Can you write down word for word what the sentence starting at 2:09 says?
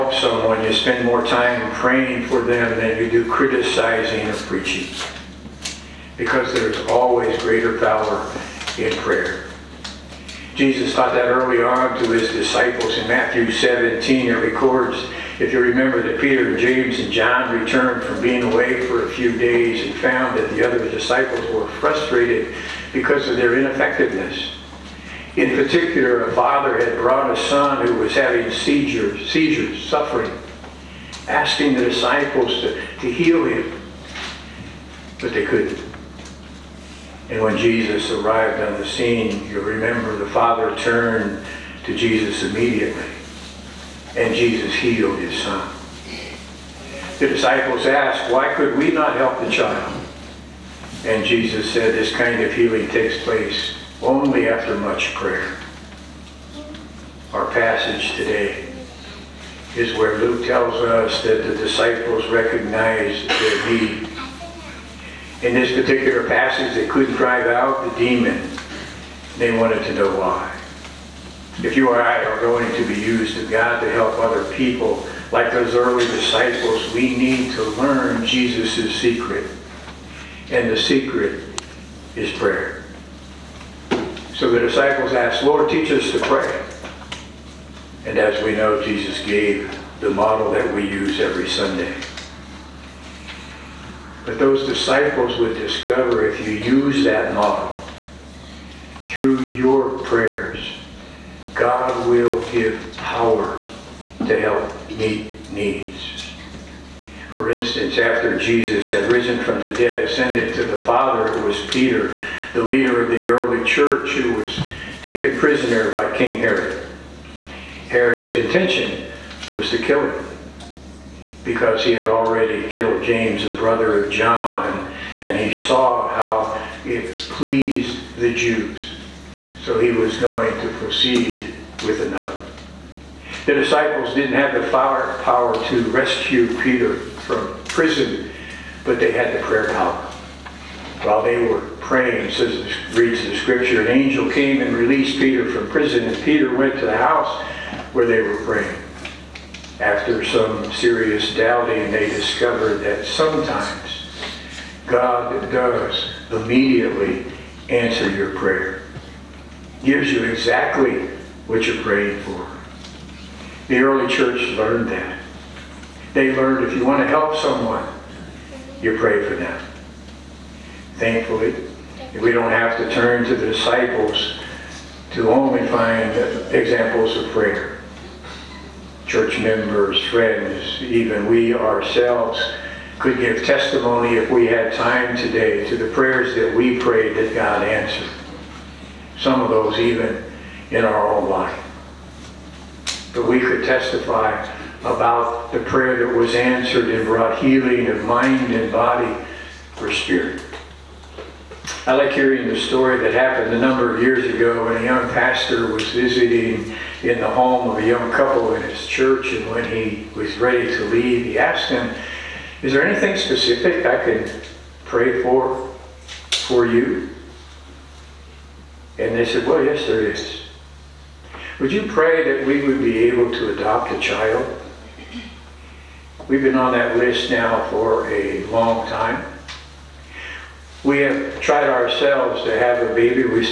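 So he was going to proceed with another.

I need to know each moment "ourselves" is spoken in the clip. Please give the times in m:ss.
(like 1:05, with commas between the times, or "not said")
3:01, 3:51.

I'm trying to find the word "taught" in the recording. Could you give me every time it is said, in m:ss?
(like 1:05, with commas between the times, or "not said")
0:10.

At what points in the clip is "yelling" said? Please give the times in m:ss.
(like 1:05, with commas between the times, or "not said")
not said.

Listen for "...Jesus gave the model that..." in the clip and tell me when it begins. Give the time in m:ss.
1:28.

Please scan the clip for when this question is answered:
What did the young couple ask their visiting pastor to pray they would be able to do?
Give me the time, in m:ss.
3:43.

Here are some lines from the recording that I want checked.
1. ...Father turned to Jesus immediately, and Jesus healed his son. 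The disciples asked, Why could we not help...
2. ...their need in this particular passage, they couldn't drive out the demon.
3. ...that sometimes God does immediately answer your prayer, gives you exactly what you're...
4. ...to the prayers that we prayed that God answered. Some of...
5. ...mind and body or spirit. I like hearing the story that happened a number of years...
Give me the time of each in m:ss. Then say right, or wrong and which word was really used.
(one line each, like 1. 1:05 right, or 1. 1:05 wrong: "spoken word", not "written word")
1. 0:40 right
2. 1:03 right
3. 2:32 right
4. 3:05 right
5. 3:18 right.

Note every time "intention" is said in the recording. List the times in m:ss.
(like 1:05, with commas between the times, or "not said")
1:58.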